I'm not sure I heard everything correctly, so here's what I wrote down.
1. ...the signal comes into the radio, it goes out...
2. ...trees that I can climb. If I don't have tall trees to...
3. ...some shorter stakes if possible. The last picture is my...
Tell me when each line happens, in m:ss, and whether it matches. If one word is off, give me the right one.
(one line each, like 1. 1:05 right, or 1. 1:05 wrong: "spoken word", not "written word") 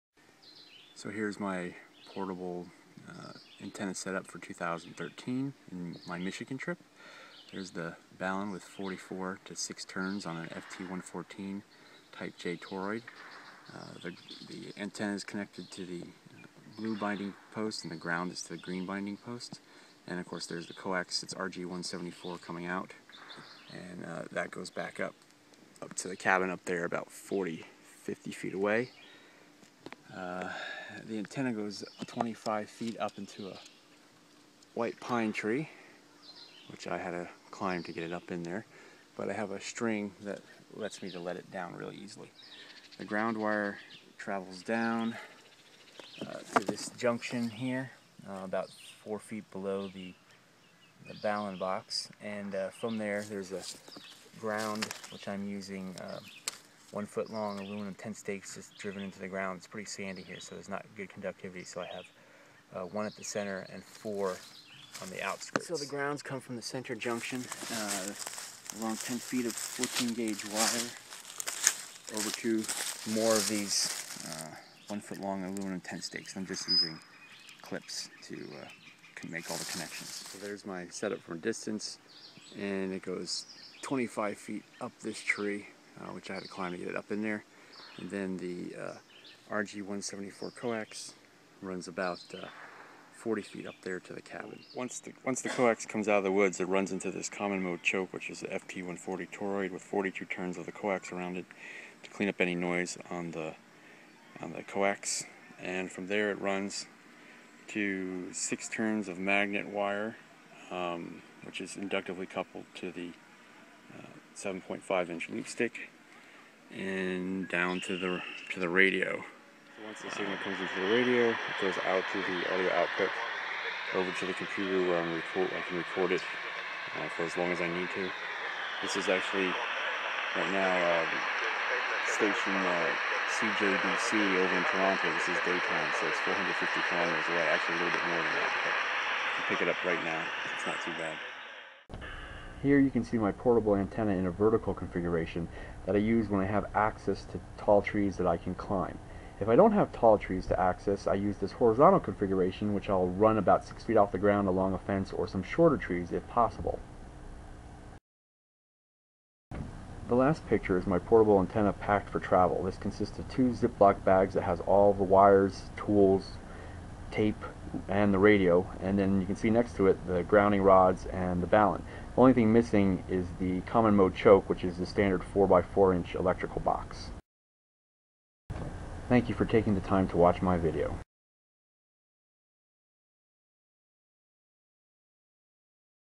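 1. 2:00 right
2. 2:27 right
3. 2:35 wrong: "trees", not "stakes".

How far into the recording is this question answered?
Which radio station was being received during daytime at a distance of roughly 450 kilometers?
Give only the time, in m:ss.
2:13.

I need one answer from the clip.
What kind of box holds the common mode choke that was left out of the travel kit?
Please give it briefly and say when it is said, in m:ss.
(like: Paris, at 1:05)
4x4 inch electrical box, at 2:55.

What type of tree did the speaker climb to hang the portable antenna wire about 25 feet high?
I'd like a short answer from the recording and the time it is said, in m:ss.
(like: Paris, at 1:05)
White pine, at 0:34.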